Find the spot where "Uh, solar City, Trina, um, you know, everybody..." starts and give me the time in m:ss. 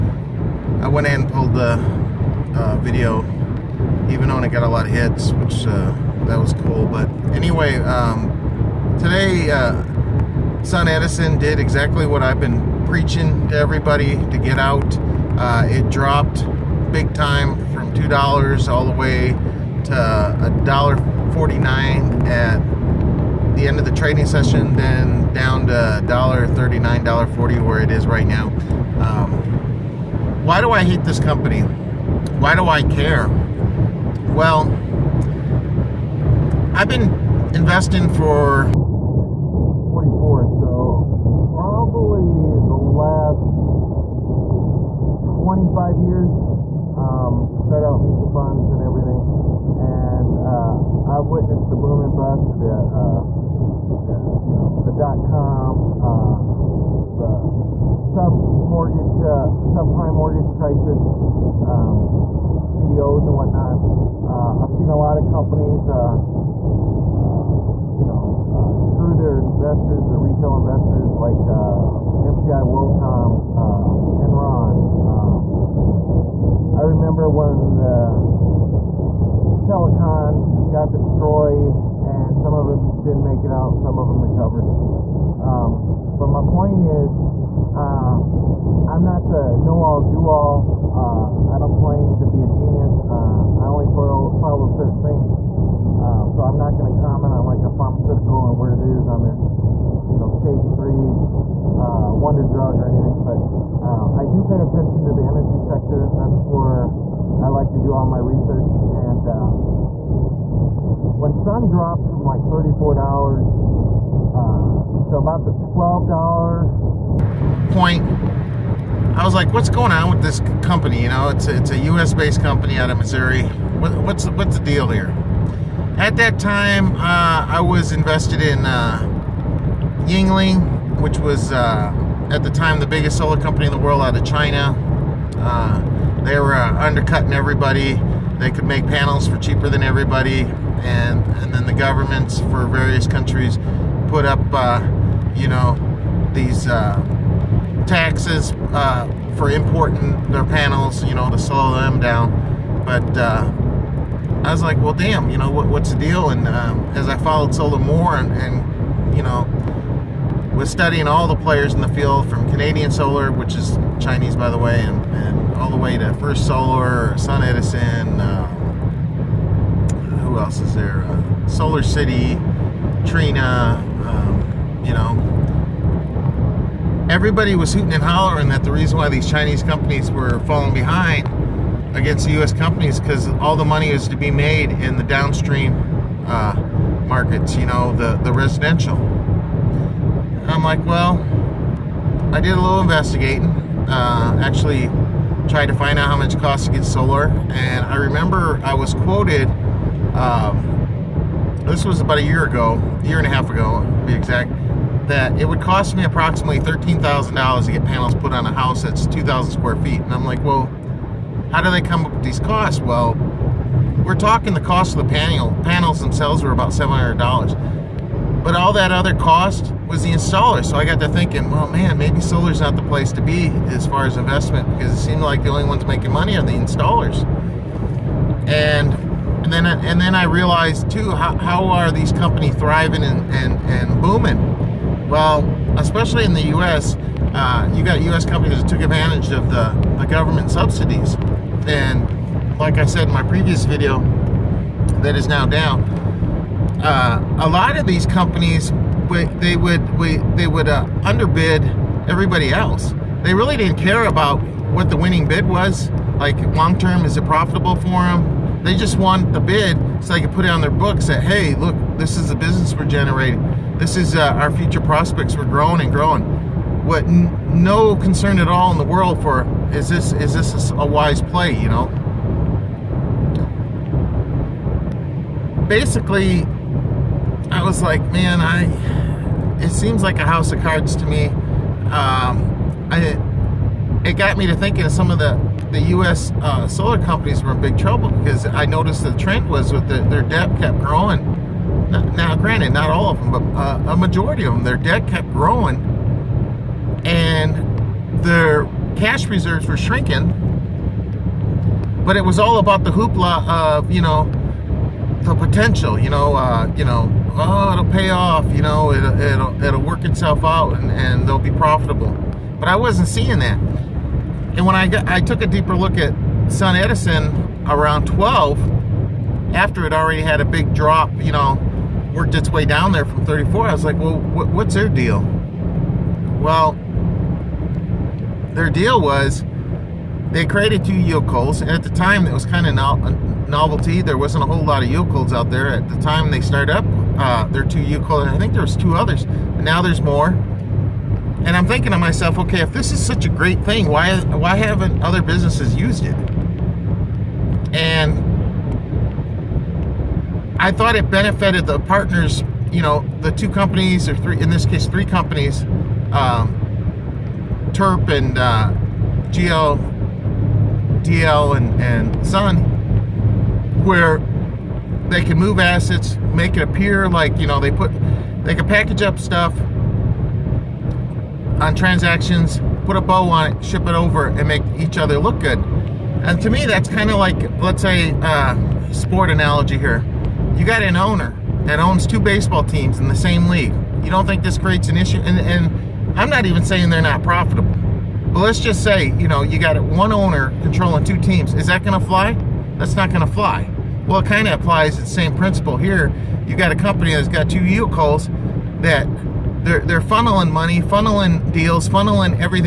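2:51.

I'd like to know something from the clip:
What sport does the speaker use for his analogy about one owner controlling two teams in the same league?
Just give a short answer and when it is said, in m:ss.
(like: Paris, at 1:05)
Baseball, at 6:22.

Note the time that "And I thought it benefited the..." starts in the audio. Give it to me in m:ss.
5:47.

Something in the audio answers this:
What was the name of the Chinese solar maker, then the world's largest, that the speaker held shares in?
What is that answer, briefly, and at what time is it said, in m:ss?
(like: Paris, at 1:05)
Yingli, at 2:10.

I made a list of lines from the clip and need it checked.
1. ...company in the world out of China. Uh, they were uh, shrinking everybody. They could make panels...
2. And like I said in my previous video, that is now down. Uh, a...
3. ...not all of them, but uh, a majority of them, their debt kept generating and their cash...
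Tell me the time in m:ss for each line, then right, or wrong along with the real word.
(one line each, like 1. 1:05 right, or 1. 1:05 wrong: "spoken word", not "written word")
1. 2:13 wrong: "undercutting", not "shrinking"
2. 4:01 right
3. 4:52 wrong: "growing", not "generating".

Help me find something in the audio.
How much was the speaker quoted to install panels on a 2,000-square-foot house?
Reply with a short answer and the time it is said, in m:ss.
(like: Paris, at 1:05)
$13,000, at 3:26.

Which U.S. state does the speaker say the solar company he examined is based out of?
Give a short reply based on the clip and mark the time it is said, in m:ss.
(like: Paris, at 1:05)
Missouri, at 2:02.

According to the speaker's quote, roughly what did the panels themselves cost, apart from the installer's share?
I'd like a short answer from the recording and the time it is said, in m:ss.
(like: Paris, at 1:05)
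$700, at 3:36.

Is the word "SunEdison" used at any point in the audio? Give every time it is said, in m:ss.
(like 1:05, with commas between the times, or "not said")
2:47, 5:16.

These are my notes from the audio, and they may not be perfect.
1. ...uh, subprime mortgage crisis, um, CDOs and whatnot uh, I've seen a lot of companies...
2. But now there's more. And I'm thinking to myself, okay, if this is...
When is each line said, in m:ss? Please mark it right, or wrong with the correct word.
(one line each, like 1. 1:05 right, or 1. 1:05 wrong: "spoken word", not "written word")
1. 0:59 right
2. 5:39 right.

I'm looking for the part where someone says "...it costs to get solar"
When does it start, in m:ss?
3:16.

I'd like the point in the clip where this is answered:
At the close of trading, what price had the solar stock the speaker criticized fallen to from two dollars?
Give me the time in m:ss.
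0:19.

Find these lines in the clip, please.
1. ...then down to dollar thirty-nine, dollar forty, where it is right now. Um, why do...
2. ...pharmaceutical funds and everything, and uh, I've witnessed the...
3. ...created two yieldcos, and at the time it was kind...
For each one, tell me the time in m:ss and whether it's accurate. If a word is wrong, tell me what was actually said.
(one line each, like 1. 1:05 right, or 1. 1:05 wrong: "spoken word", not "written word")
1. 0:24 right
2. 0:48 wrong: "mutual", not "pharmaceutical"
3. 5:30 right.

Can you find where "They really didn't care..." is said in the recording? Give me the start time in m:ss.
4:13.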